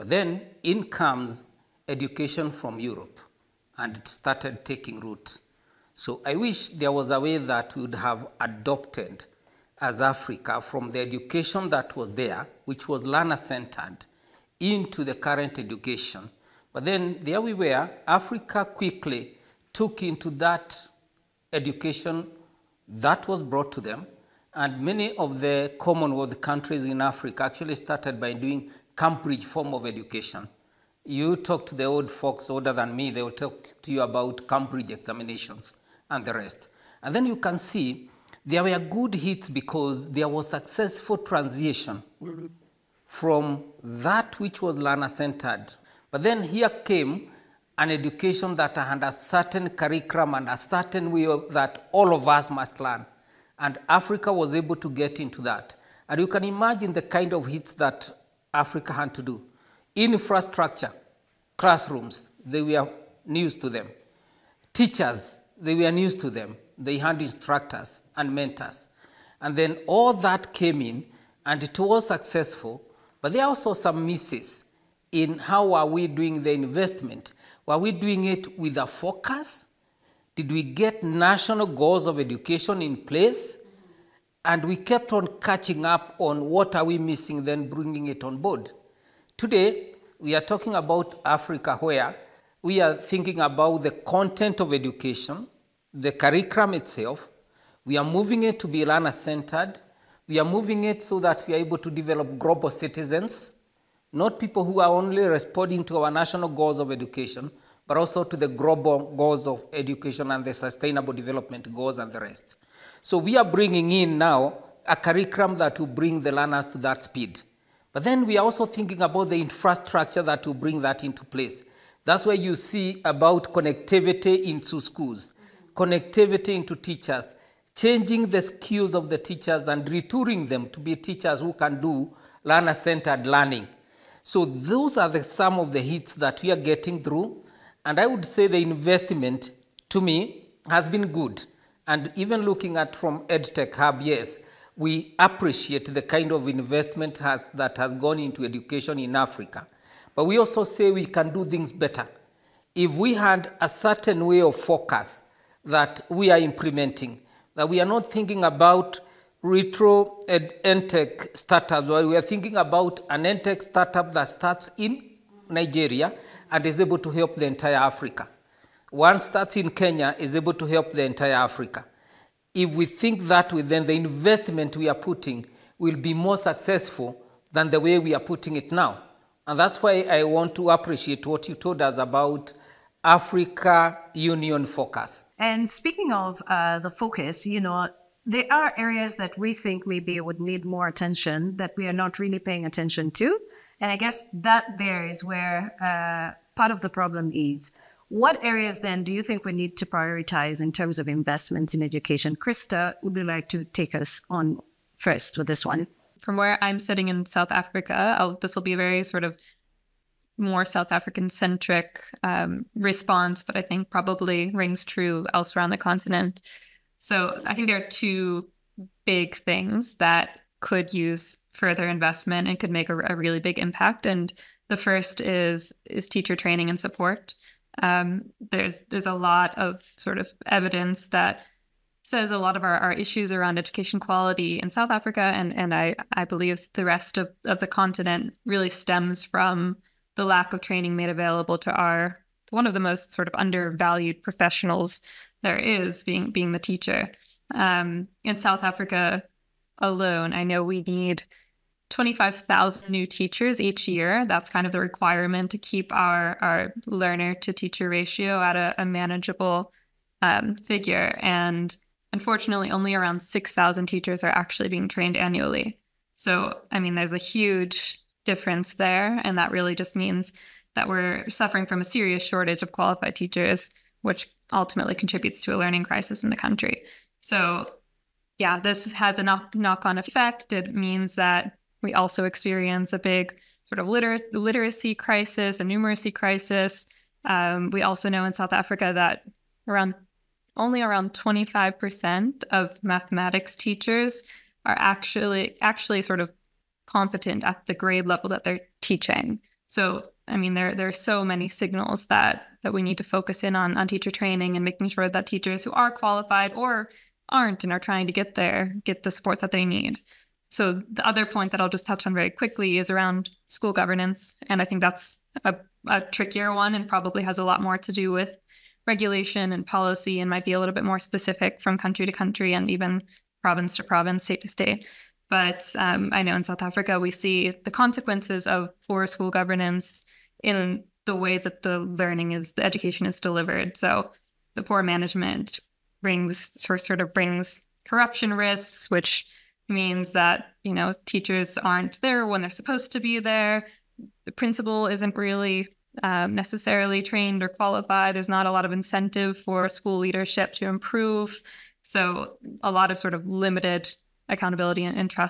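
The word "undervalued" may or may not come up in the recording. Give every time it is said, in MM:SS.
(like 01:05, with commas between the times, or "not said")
04:03.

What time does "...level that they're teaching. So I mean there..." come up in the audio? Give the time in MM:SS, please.
04:58.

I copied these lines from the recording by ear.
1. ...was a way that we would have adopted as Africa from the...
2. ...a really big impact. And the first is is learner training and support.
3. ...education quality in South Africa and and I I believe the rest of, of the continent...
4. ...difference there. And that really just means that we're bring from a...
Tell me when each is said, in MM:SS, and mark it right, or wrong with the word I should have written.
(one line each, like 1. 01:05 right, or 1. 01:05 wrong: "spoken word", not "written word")
1. 00:06 right
2. 03:43 wrong: "teacher", not "learner"
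3. 03:53 right
4. 04:28 wrong: "suffering", not "bring".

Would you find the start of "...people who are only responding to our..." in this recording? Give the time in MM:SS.
01:44.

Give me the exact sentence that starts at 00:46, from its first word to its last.
But then here came an education that had a certain curriculum and a certain way of, that all of us must learn.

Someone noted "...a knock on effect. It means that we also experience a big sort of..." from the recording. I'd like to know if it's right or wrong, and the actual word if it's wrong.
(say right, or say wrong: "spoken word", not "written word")
right.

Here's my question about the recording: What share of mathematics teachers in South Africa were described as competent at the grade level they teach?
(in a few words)
25%.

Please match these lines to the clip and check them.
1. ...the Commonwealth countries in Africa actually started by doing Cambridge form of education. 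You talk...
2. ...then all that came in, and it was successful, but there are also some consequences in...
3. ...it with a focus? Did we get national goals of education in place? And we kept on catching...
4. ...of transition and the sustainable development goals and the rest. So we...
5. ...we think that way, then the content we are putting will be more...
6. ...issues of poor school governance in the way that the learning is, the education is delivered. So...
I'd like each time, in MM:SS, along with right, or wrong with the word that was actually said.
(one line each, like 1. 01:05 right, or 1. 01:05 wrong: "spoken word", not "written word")
1. 00:25 right
2. 01:09 wrong: "misses", not "consequences"
3. 01:18 right
4. 01:49 wrong: "education", not "transition"
5. 02:52 wrong: "investment", not "content"
6. 05:27 wrong: "consequences", not "issues".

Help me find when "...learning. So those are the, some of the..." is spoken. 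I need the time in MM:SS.
02:13.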